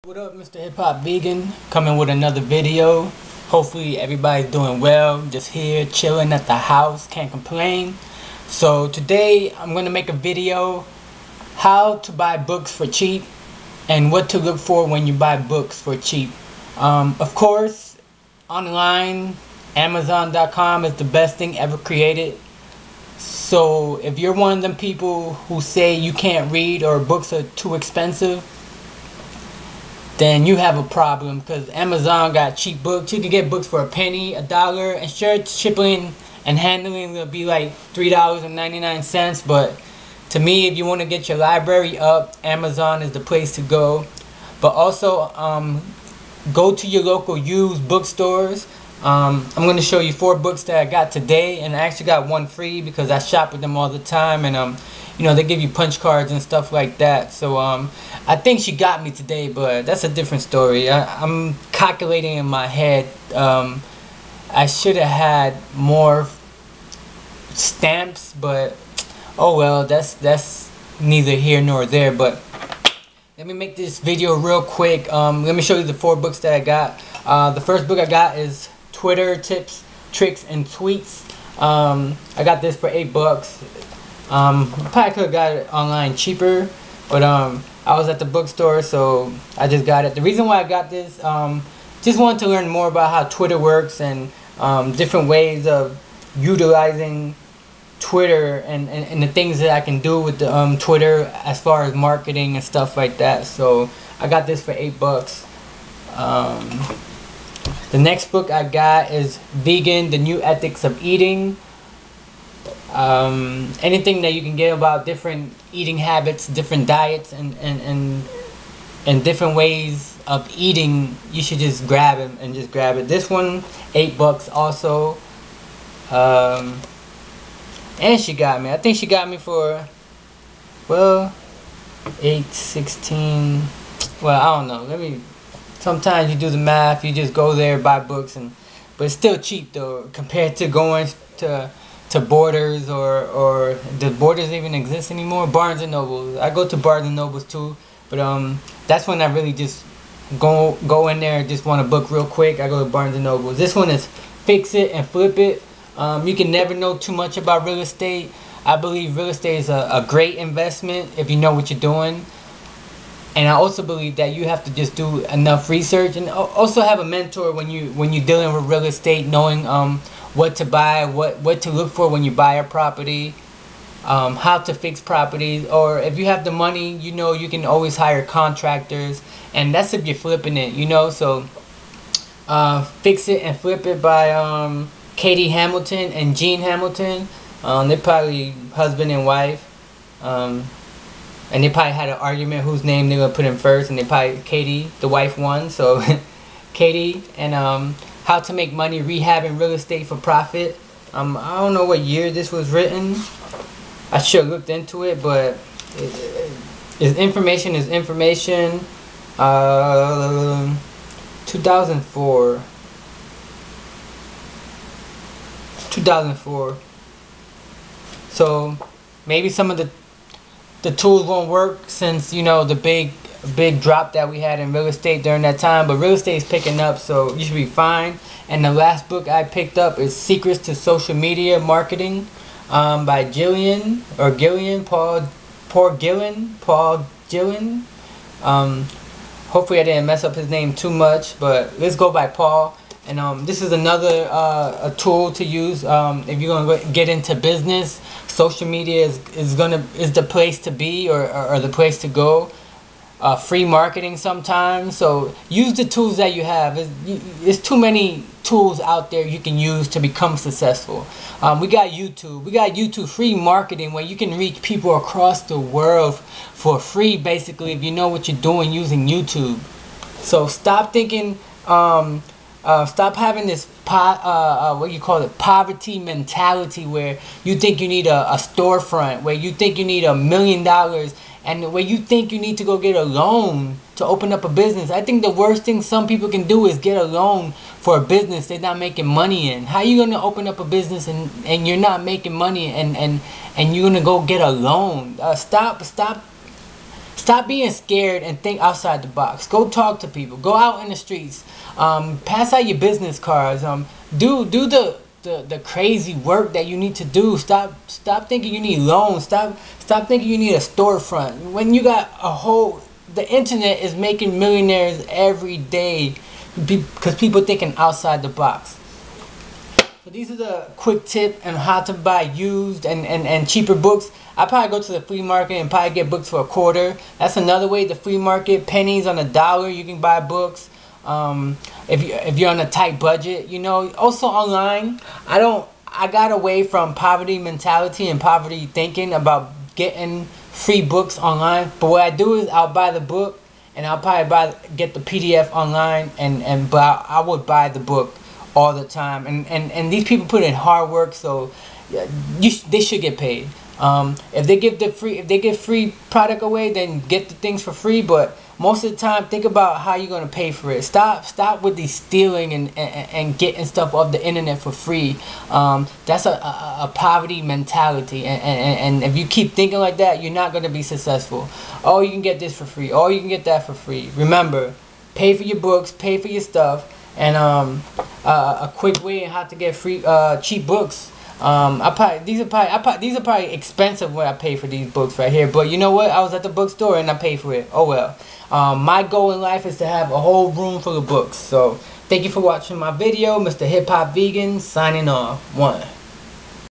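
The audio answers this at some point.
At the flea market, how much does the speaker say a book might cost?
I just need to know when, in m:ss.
5:26.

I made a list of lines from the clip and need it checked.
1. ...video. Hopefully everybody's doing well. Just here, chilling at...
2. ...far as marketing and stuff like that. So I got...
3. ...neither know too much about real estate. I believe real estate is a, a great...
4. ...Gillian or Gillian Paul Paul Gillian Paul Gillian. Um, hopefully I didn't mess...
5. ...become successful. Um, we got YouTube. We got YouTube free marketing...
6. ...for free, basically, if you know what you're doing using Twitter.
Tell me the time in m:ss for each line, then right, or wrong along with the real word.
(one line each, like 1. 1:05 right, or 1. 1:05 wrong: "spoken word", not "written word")
1. 0:02 right
2. 1:41 right
3. 2:36 wrong: "never", not "neither"
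4. 3:53 right
5. 4:19 right
6. 4:26 wrong: "YouTube", not "Twitter".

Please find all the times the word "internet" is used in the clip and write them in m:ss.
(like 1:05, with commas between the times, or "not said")
5:13, 6:04.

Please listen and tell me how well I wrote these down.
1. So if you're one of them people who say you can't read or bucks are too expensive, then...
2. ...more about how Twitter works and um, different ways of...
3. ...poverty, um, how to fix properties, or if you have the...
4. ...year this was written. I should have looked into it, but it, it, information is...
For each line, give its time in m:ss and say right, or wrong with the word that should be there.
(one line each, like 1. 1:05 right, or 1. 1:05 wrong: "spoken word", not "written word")
1. 0:23 wrong: "books", not "bucks"
2. 1:32 right
3. 2:52 wrong: "property", not "poverty"
4. 3:21 right.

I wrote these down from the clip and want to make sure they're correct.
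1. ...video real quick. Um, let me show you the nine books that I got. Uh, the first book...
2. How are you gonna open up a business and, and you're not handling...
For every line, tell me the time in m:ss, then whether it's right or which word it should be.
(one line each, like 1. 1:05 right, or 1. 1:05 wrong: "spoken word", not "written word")
1. 1:13 wrong: "four", not "nine"
2. 4:49 wrong: "making", not "handling".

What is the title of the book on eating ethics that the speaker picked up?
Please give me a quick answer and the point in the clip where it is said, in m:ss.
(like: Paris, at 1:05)
Vegan, The New Ethics of Eating, at 1:49.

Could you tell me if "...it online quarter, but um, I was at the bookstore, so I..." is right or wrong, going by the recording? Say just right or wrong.
wrong.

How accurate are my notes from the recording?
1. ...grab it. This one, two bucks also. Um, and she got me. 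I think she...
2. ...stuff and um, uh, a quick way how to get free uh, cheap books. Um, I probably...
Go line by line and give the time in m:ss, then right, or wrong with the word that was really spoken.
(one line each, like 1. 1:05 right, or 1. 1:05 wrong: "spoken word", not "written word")
1. 2:02 wrong: "eight", not "two"
2. 6:16 right.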